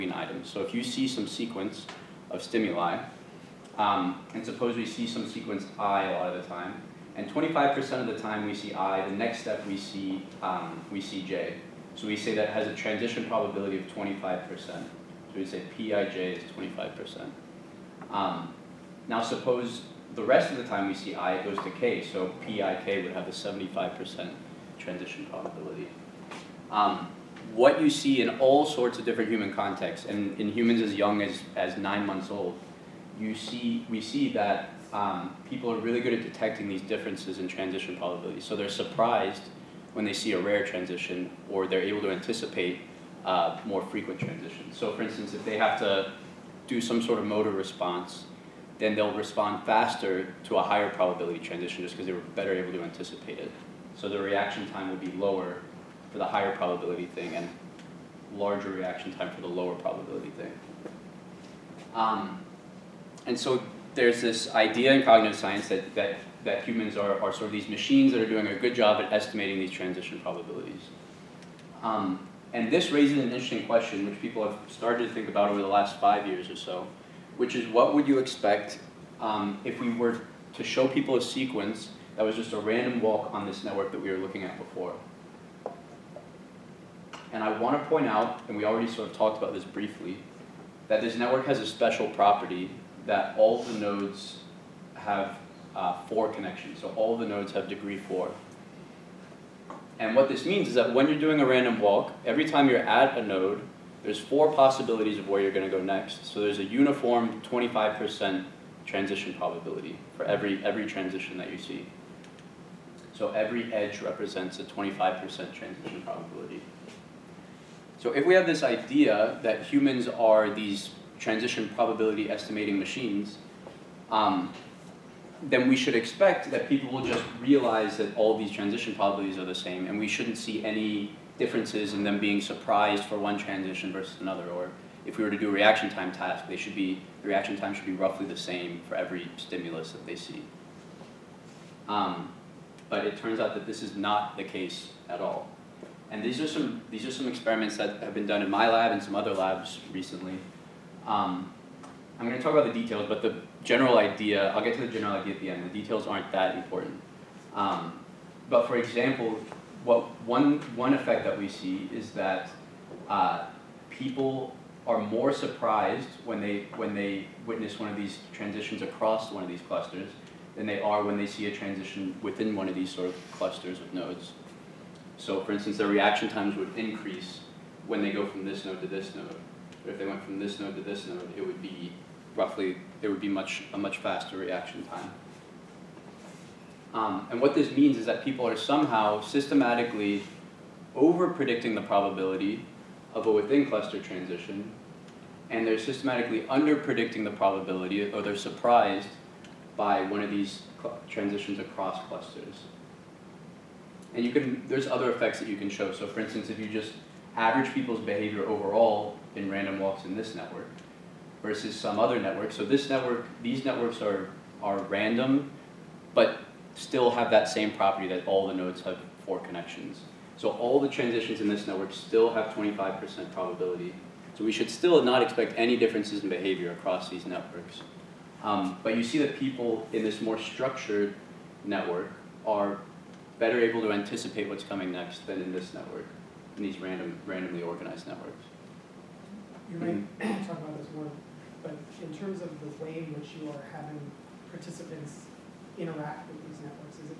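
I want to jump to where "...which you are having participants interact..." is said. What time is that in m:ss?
4:03.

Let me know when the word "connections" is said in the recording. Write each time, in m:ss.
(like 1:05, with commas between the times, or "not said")
1:36, 3:39.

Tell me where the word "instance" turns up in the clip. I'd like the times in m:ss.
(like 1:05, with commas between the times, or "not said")
0:45, 2:55, 3:26.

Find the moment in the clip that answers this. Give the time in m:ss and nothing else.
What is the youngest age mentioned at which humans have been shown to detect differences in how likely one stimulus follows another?
0:31.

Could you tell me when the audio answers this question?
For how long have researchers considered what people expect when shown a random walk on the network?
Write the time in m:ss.
1:15.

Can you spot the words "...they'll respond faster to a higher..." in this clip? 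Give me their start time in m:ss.
0:48.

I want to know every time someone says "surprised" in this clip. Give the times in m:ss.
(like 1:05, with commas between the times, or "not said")
0:38, 2:12, 2:45, 3:18.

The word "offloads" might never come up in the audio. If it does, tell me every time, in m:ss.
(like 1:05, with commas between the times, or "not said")
not said.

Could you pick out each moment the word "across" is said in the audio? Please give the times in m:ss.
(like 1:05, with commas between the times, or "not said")
2:48, 3:21, 3:46.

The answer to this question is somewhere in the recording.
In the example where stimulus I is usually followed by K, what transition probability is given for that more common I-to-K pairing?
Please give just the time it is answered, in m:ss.
0:23.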